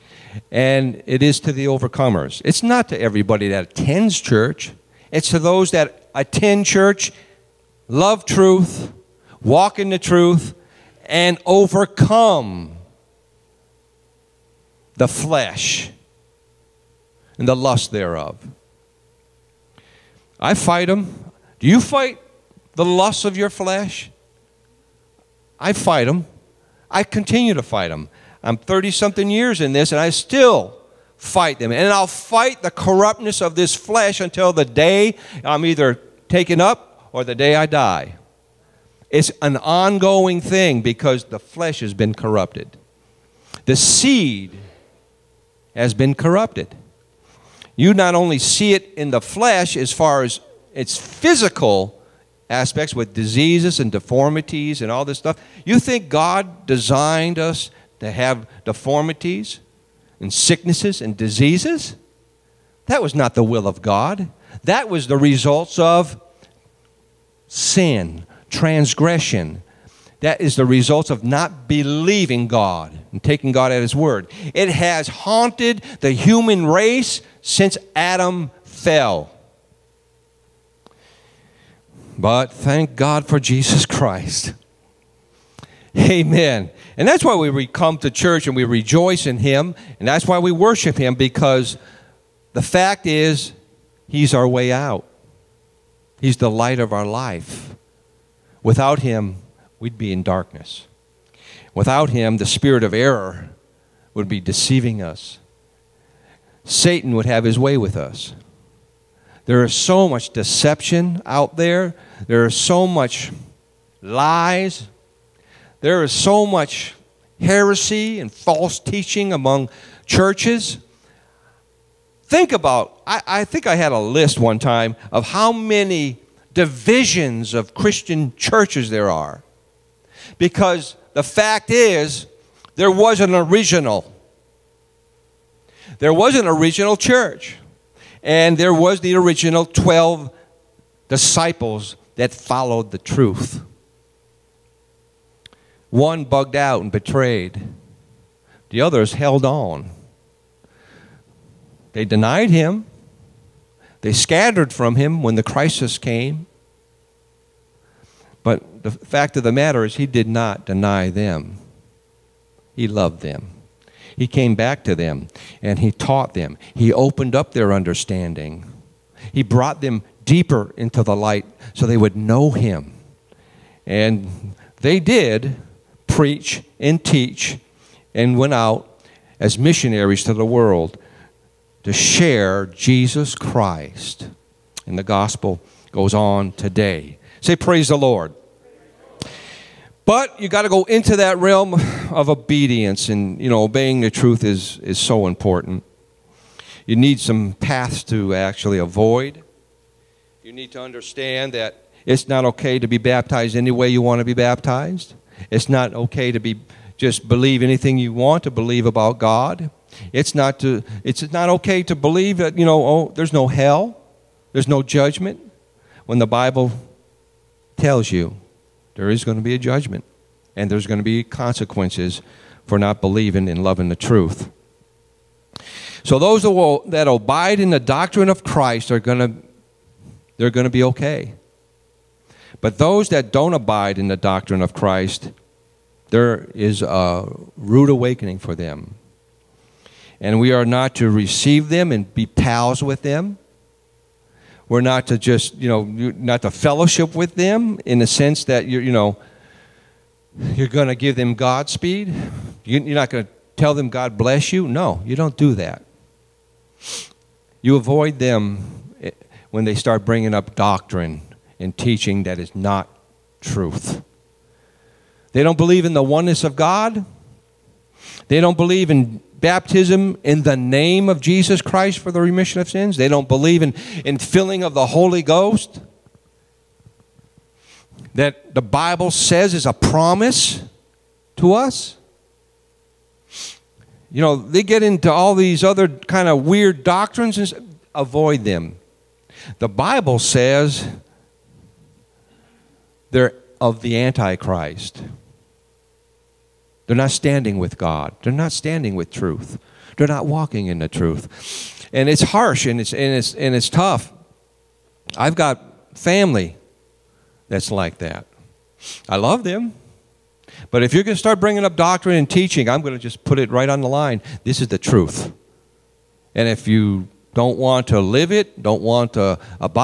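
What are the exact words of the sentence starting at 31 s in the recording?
And I'll fight the corruptness of this flesh until the day I'm either taken up or the day I die.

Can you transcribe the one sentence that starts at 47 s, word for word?
You not only see it in the flesh as far as its physical aspects with diseases and deformities and all this stuff.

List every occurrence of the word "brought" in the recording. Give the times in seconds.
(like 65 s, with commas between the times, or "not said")
169 s.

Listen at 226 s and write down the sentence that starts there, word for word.
So those that, will, that abide in the doctrine of Christ are going to they're going to be okay.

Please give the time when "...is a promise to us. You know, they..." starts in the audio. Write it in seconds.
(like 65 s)
279 s.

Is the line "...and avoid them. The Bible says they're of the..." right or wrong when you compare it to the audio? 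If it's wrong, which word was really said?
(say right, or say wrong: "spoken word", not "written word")
right.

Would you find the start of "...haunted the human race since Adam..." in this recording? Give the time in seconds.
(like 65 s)
75 s.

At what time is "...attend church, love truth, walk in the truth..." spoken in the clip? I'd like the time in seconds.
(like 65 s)
6 s.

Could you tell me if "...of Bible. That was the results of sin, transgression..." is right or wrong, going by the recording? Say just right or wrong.
wrong.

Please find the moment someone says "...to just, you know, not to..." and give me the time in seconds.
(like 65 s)
245 s.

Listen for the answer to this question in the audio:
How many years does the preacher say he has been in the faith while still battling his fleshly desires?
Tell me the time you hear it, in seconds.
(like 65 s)
28 s.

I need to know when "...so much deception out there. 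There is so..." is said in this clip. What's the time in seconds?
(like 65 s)
109 s.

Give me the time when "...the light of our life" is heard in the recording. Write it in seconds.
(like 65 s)
96 s.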